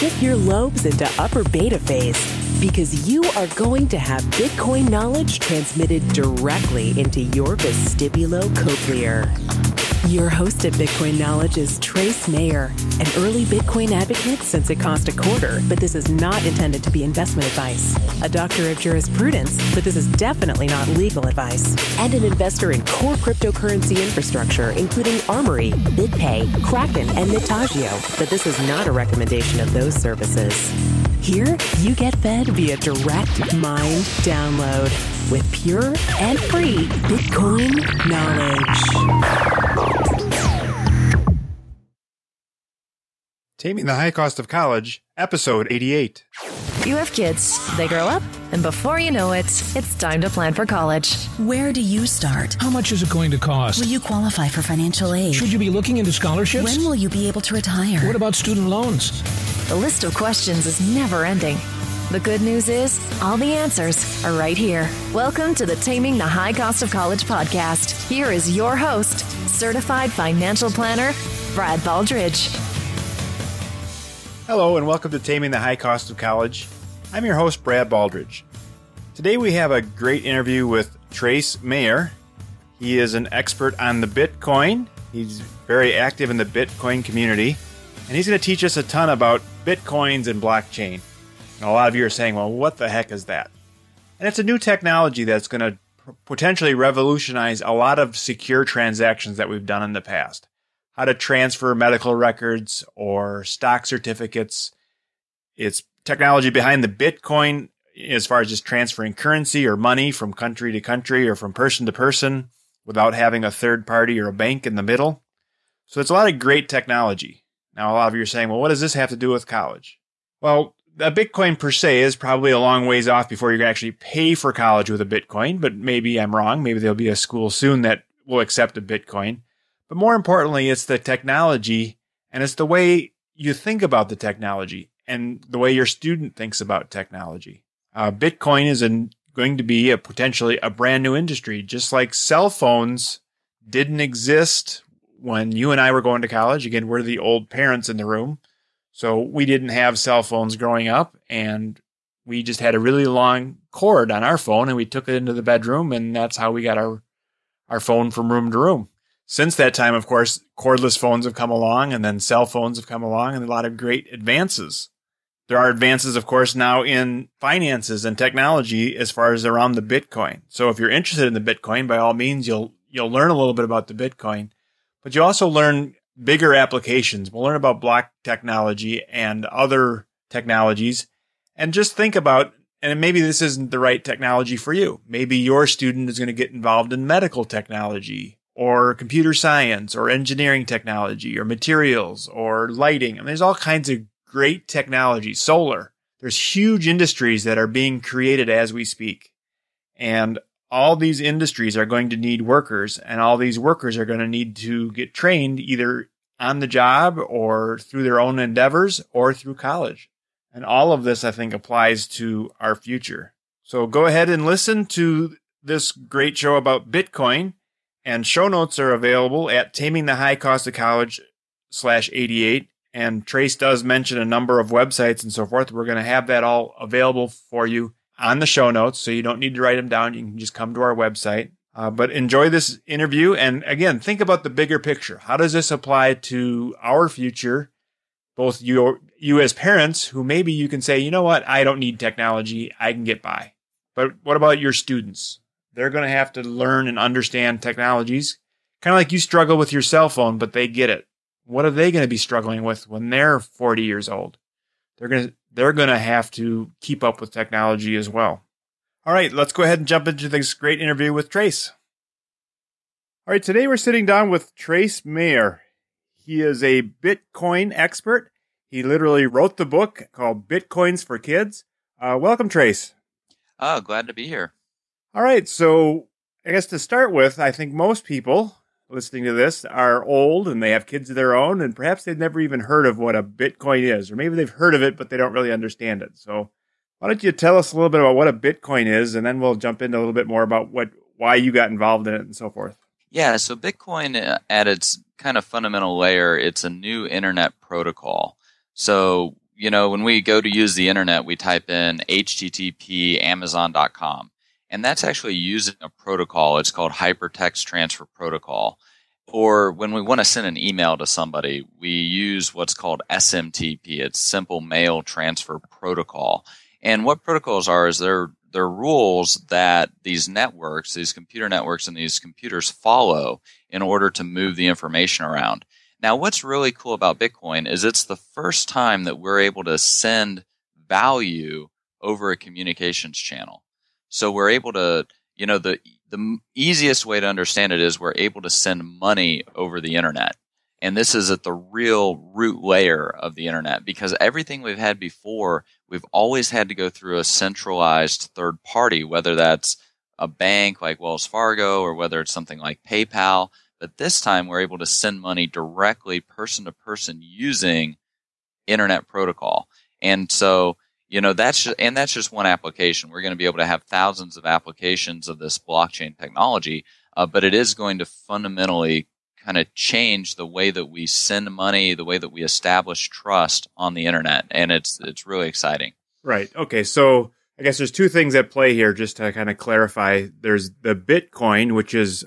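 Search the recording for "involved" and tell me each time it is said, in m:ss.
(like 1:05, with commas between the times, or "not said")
3:06, 4:51.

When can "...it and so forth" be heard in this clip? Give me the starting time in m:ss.
4:52.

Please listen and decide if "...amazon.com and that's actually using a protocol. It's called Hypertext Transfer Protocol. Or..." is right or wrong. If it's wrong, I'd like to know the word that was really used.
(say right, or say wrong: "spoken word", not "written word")
right.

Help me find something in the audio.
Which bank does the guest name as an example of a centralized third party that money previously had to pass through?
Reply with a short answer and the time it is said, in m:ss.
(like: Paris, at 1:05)
Wells Fargo, at 5:51.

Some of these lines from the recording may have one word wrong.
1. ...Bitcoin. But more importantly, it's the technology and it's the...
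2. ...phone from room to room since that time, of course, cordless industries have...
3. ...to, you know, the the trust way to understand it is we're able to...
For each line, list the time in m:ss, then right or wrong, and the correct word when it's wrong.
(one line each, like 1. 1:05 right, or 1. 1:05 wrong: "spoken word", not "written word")
1. 2:08 right
2. 2:37 wrong: "phones", not "industries"
3. 5:34 wrong: "easiest", not "trust".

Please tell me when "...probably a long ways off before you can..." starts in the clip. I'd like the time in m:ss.
2:02.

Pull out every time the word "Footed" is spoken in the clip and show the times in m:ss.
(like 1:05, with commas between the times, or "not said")
not said.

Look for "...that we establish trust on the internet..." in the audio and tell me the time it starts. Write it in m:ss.
6:12.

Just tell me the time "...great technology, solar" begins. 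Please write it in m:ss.
3:14.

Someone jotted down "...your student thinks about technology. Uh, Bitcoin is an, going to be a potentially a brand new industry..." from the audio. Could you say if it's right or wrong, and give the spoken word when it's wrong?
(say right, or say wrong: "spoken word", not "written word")
right.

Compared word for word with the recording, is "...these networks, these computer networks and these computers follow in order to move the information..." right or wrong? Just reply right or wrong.
right.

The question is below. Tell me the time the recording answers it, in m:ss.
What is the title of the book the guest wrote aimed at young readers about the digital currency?
4:30.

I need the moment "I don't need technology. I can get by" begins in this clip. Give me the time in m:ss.
4:01.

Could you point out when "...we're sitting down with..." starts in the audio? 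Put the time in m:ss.
4:23.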